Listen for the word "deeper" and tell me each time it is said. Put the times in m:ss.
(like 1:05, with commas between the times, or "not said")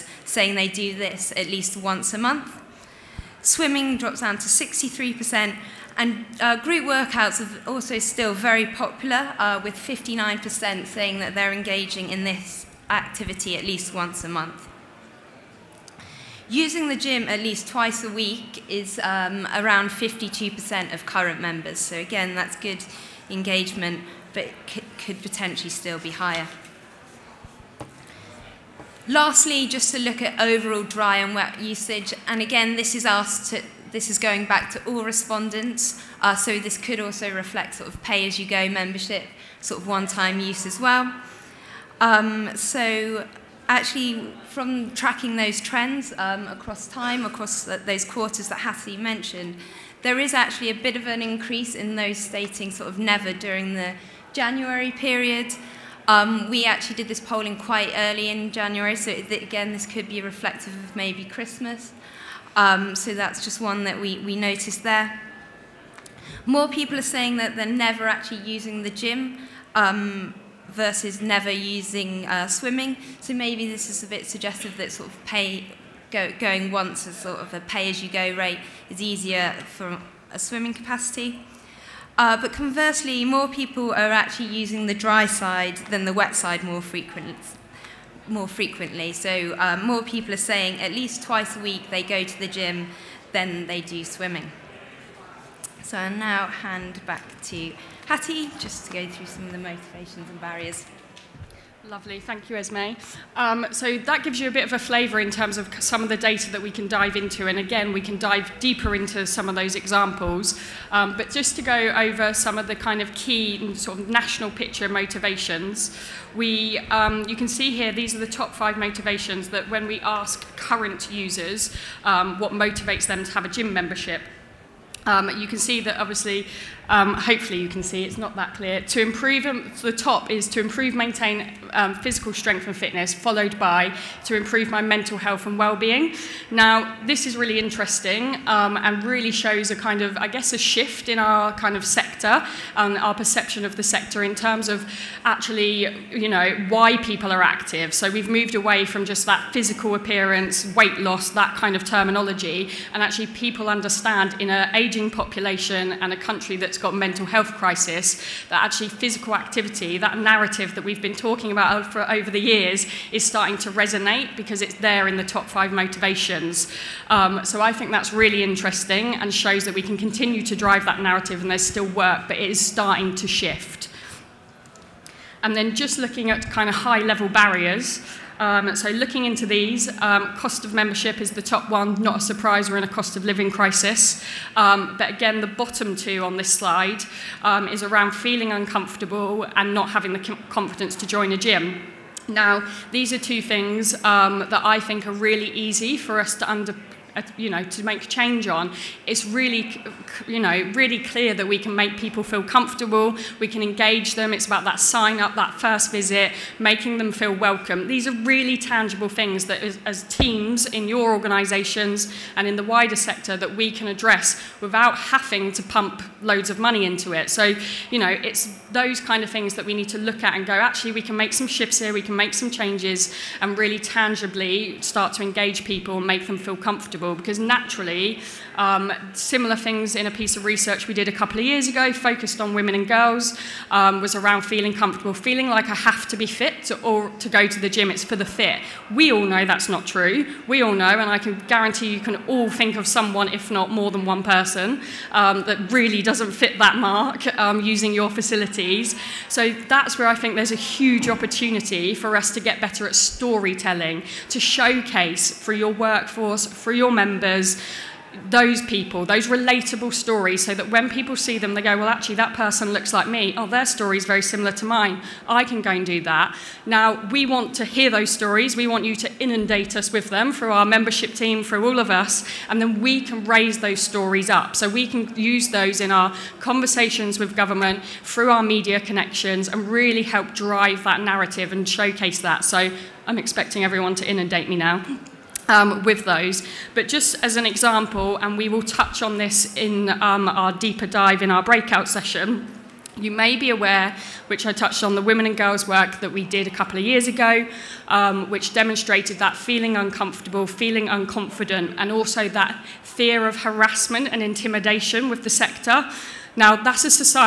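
1:48, 4:50.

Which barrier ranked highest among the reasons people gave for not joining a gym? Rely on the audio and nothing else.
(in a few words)
Cost of membership.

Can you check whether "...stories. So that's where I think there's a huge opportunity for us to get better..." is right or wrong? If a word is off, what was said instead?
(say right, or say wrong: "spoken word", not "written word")
wrong: "facilities", not "stories".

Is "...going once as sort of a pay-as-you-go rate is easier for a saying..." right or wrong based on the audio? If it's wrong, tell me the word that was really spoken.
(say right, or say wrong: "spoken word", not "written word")
wrong: "swimming", not "saying".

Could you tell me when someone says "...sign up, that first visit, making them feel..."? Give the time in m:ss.
3:24.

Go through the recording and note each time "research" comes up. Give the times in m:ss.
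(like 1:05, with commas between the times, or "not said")
3:50.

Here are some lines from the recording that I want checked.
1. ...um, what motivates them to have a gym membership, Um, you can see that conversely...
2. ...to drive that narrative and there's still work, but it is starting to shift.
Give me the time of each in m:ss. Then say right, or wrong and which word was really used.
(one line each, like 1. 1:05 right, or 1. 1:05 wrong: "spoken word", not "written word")
1. 2:02 wrong: "obviously", not "conversely"
2. 2:50 right.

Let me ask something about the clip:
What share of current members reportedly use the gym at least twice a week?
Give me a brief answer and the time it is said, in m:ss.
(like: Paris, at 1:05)
52%, at 0:19.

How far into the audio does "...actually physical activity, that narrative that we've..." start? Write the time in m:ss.
2:38.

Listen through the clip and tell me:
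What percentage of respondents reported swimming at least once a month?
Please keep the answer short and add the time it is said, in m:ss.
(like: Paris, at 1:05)
63%, at 0:04.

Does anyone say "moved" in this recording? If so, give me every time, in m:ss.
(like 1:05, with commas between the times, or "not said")
2:28.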